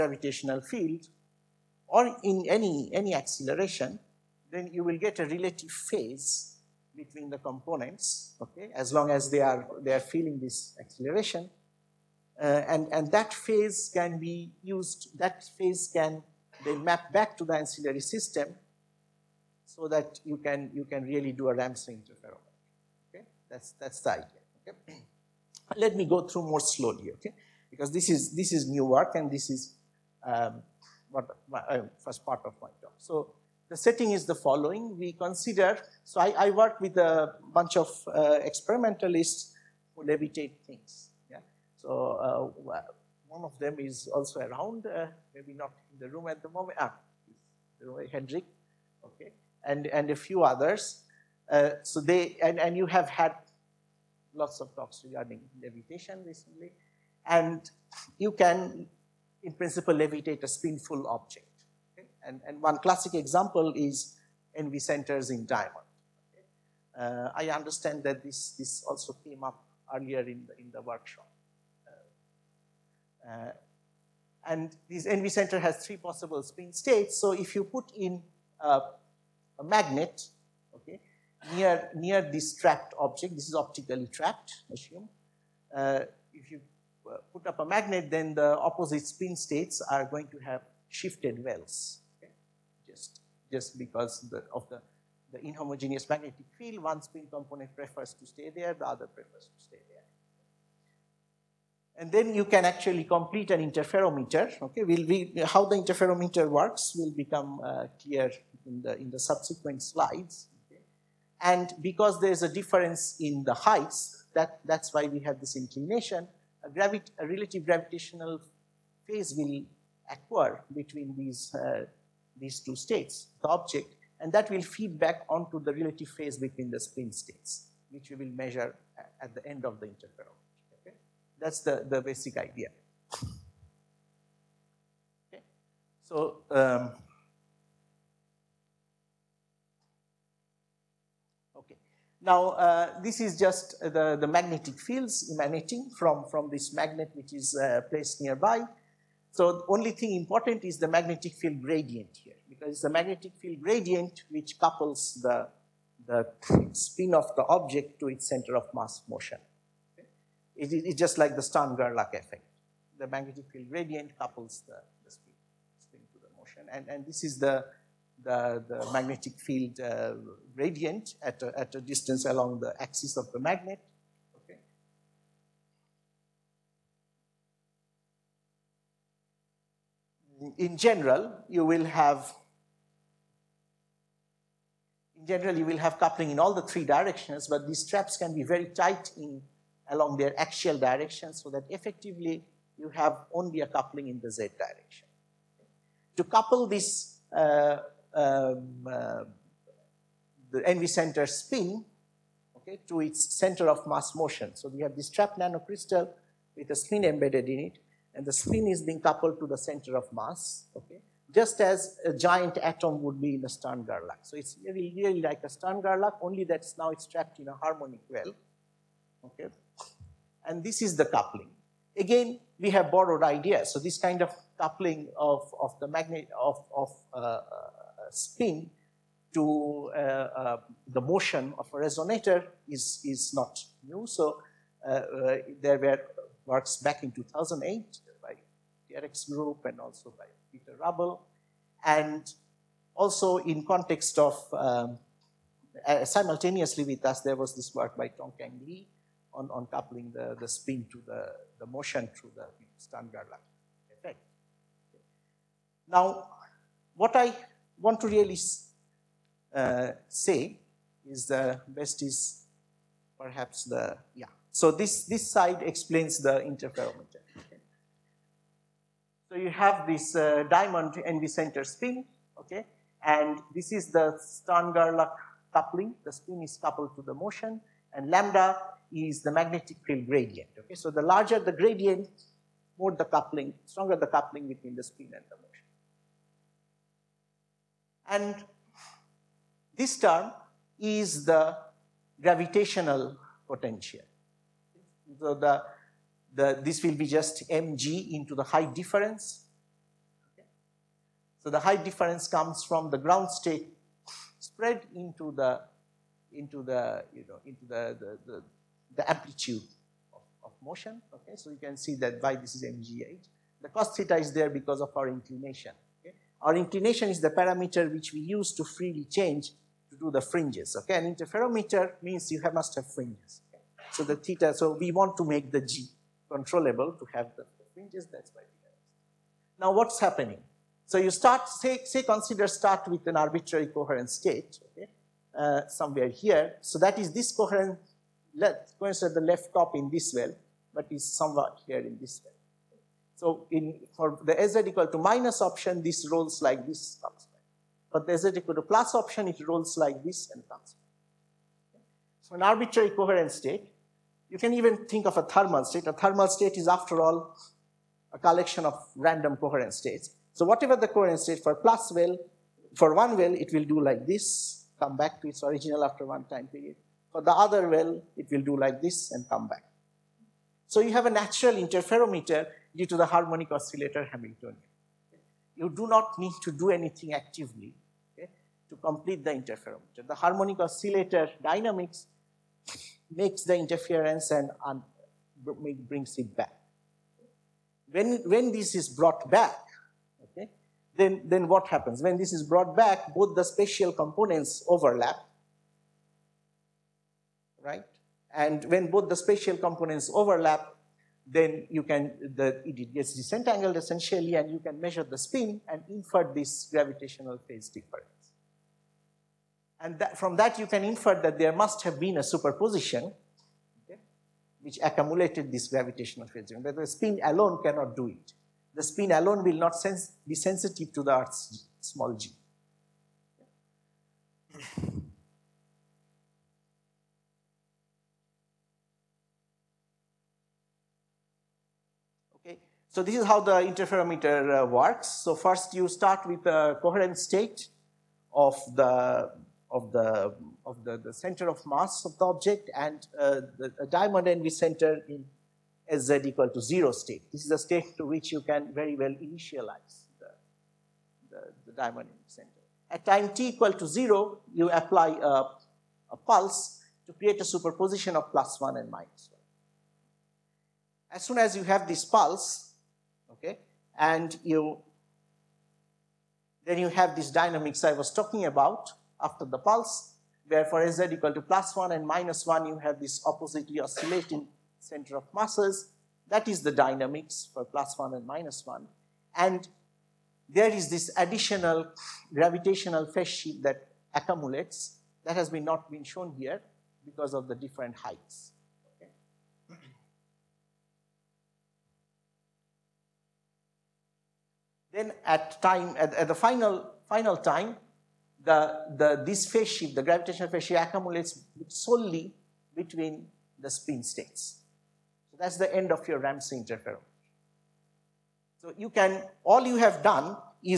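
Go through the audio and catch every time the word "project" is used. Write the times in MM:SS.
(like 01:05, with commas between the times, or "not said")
not said.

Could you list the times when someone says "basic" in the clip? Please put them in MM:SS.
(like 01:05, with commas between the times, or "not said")
02:12.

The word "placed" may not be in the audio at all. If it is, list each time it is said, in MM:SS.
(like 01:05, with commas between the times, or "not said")
02:27.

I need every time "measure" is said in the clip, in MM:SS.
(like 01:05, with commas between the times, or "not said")
02:08, 06:44.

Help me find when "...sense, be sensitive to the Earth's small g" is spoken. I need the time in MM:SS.
06:59.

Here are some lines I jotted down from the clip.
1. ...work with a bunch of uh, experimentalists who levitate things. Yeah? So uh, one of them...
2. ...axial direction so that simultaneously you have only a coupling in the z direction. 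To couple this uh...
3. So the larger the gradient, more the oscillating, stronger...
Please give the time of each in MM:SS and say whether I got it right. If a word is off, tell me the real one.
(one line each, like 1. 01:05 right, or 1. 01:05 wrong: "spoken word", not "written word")
1. 00:36 right
2. 03:10 wrong: "effectively", not "simultaneously"
3. 04:40 wrong: "coupling", not "oscillating".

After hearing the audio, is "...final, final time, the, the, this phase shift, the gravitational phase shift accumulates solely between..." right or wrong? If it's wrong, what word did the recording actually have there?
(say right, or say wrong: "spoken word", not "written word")
right.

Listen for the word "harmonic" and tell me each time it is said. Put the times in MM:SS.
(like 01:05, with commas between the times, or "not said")
03:37, 06:13, 06:20.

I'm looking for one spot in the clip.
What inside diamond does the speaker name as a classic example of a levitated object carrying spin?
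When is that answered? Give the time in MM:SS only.
01:04.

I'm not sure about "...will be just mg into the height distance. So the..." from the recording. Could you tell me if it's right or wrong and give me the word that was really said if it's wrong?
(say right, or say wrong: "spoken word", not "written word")
wrong: "difference", not "distance".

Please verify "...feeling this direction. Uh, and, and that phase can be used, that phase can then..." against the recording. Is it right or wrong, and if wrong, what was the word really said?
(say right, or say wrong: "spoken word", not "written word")
wrong: "acceleration", not "direction".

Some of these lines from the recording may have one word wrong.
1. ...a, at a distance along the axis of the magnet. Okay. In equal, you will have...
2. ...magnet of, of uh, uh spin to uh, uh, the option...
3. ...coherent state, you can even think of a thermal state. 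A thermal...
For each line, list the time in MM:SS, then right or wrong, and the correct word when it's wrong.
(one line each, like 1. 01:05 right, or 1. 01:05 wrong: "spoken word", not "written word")
1. 02:51 wrong: "general", not "equal"
2. 03:45 wrong: "motion", not "option"
3. 05:52 right.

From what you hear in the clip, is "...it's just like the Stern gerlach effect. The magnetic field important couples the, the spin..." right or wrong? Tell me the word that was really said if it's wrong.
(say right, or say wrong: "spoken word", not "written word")
wrong: "gradient", not "important".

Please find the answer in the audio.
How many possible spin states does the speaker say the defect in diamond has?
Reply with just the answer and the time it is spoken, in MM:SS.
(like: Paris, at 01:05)
3, at 01:15.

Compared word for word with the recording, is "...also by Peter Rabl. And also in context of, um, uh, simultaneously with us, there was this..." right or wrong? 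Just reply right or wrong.
right.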